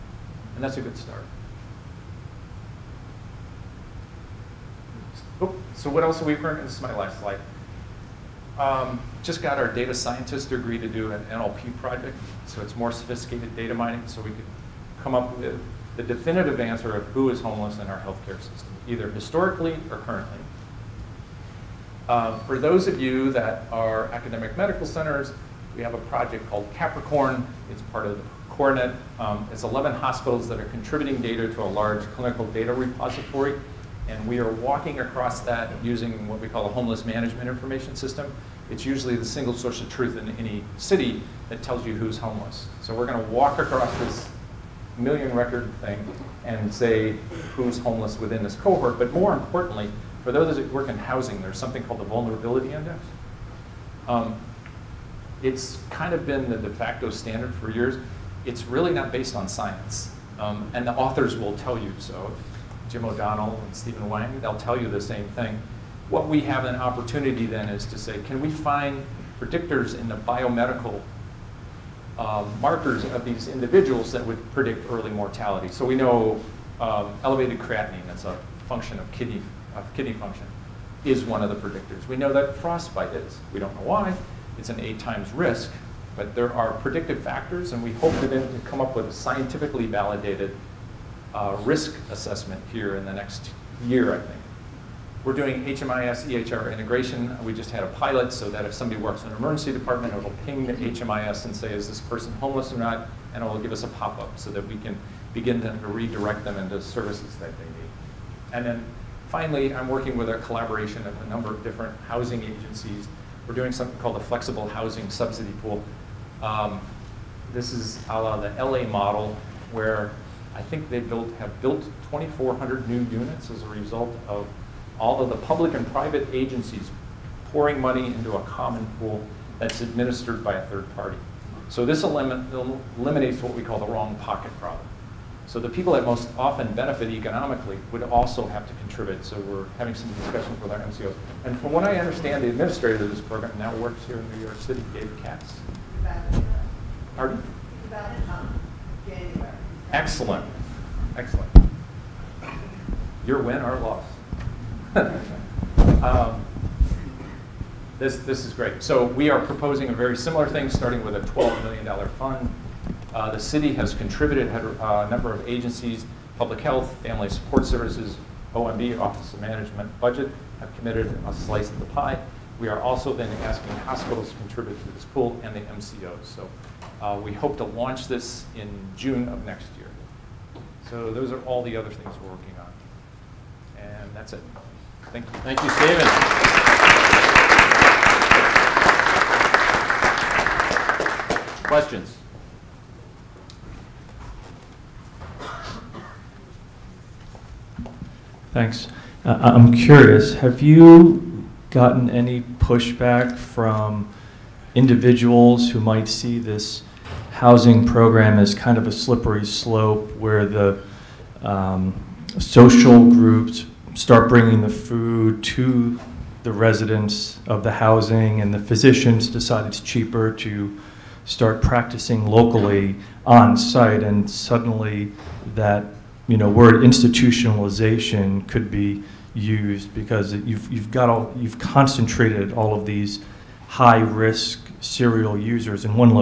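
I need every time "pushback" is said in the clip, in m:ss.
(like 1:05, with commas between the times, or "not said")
3:22.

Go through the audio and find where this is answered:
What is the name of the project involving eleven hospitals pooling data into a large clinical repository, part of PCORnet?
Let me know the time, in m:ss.
0:26.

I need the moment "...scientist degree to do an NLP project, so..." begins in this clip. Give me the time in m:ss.
0:09.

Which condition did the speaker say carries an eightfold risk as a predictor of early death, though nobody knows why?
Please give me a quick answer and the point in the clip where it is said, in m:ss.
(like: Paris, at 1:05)
frostbite, at 1:22.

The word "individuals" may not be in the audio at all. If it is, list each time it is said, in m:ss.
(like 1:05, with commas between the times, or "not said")
1:13, 3:24.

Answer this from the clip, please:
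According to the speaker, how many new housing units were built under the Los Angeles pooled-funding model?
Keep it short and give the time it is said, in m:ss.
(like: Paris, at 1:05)
2,400, at 2:02.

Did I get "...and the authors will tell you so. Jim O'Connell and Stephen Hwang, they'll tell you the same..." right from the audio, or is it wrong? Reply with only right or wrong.
right.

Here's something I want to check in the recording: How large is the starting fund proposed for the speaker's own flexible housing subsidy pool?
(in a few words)
$12 million.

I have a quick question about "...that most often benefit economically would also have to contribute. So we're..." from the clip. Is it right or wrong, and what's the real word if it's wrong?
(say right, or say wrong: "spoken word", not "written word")
right.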